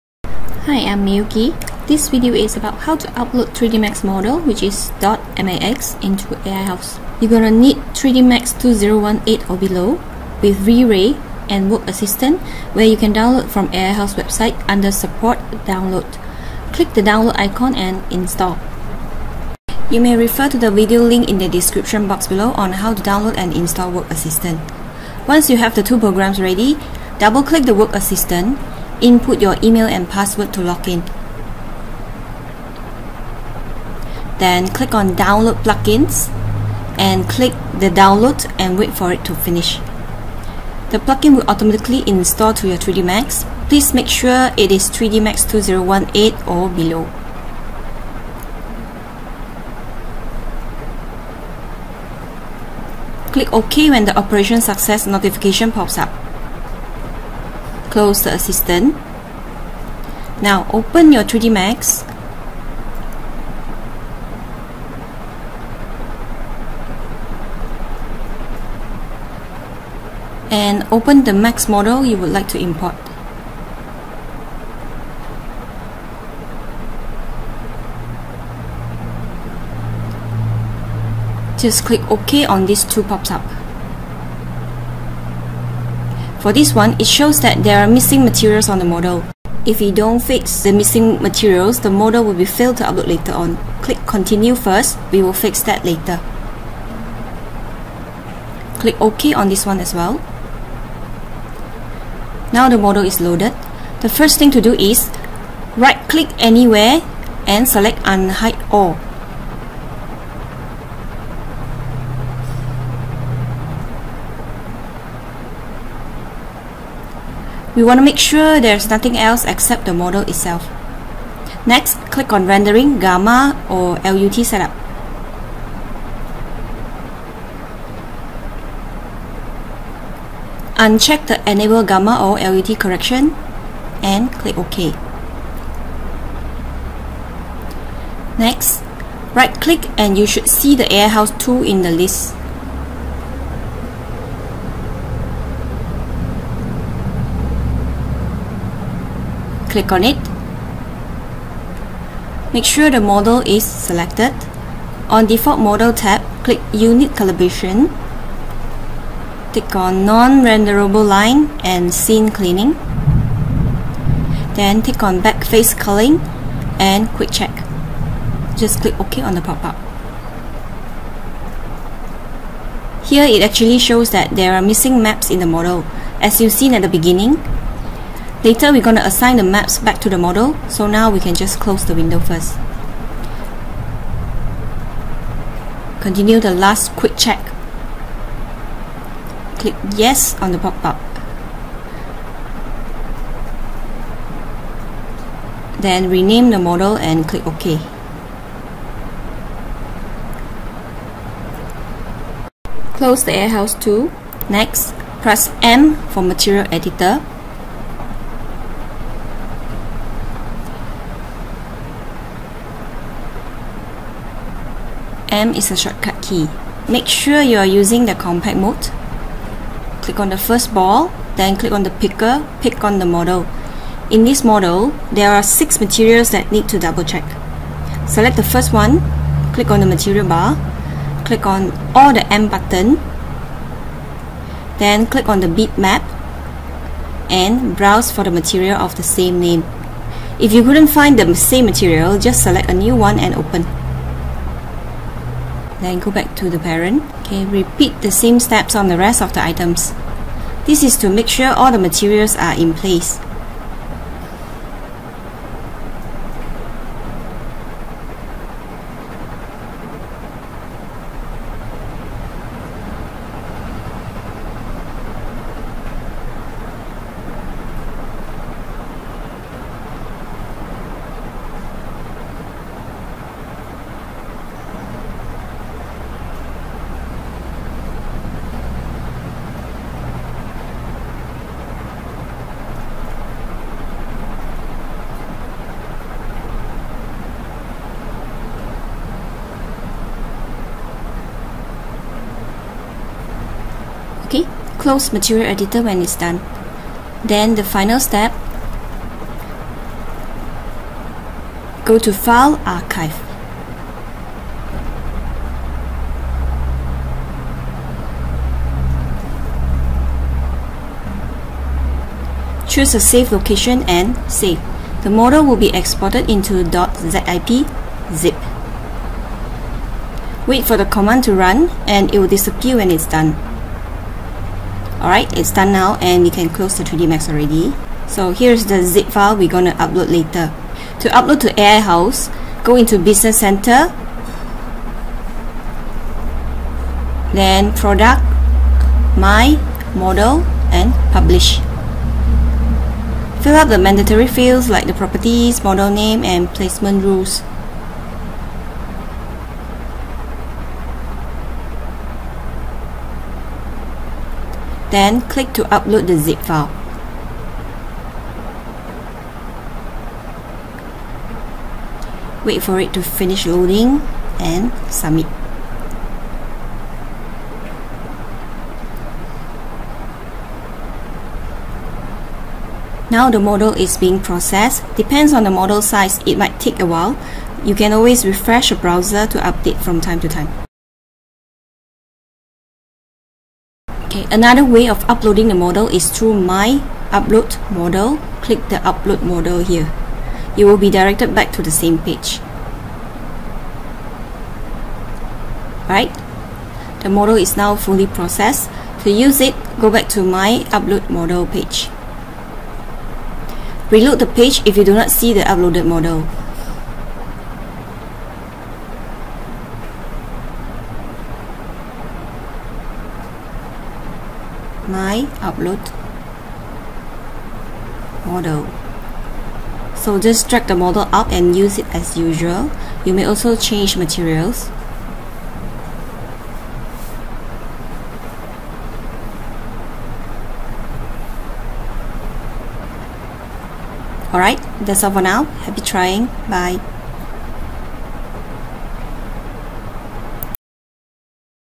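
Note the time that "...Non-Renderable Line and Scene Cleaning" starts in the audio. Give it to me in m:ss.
2:40.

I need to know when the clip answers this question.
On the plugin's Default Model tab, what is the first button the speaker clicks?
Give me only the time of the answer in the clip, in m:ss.
2:36.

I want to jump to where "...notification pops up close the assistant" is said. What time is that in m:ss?
0:55.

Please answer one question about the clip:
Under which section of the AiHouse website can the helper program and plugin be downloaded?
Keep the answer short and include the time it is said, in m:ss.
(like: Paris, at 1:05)
Support Download, at 0:14.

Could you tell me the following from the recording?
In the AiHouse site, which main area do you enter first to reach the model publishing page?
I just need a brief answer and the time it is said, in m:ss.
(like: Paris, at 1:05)
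business center, at 5:32.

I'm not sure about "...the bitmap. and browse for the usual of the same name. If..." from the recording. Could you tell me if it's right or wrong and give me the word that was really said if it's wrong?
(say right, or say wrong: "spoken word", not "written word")
wrong: "material", not "usual".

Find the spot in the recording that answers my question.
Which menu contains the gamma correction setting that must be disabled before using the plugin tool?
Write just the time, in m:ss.
2:02.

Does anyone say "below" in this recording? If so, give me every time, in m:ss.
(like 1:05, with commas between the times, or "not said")
0:09, 0:22, 0:46.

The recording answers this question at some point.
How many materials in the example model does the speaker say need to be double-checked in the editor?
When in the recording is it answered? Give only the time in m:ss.
3:45.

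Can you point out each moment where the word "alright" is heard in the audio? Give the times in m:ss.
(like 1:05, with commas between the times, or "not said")
5:25, 7:14.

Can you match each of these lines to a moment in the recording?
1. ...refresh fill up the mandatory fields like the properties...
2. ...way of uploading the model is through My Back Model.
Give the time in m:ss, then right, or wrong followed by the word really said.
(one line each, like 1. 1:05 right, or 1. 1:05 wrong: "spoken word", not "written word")
1. 5:41 wrong: "publish", not "refresh"
2. 6:24 wrong: "Upload", not "Back".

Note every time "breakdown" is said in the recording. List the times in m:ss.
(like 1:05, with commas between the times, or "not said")
not said.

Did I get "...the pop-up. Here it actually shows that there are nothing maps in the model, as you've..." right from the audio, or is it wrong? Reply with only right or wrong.
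wrong.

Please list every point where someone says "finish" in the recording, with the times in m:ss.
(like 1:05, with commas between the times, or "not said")
0:39, 6:03.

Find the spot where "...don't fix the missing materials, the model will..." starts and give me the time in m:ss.
1:29.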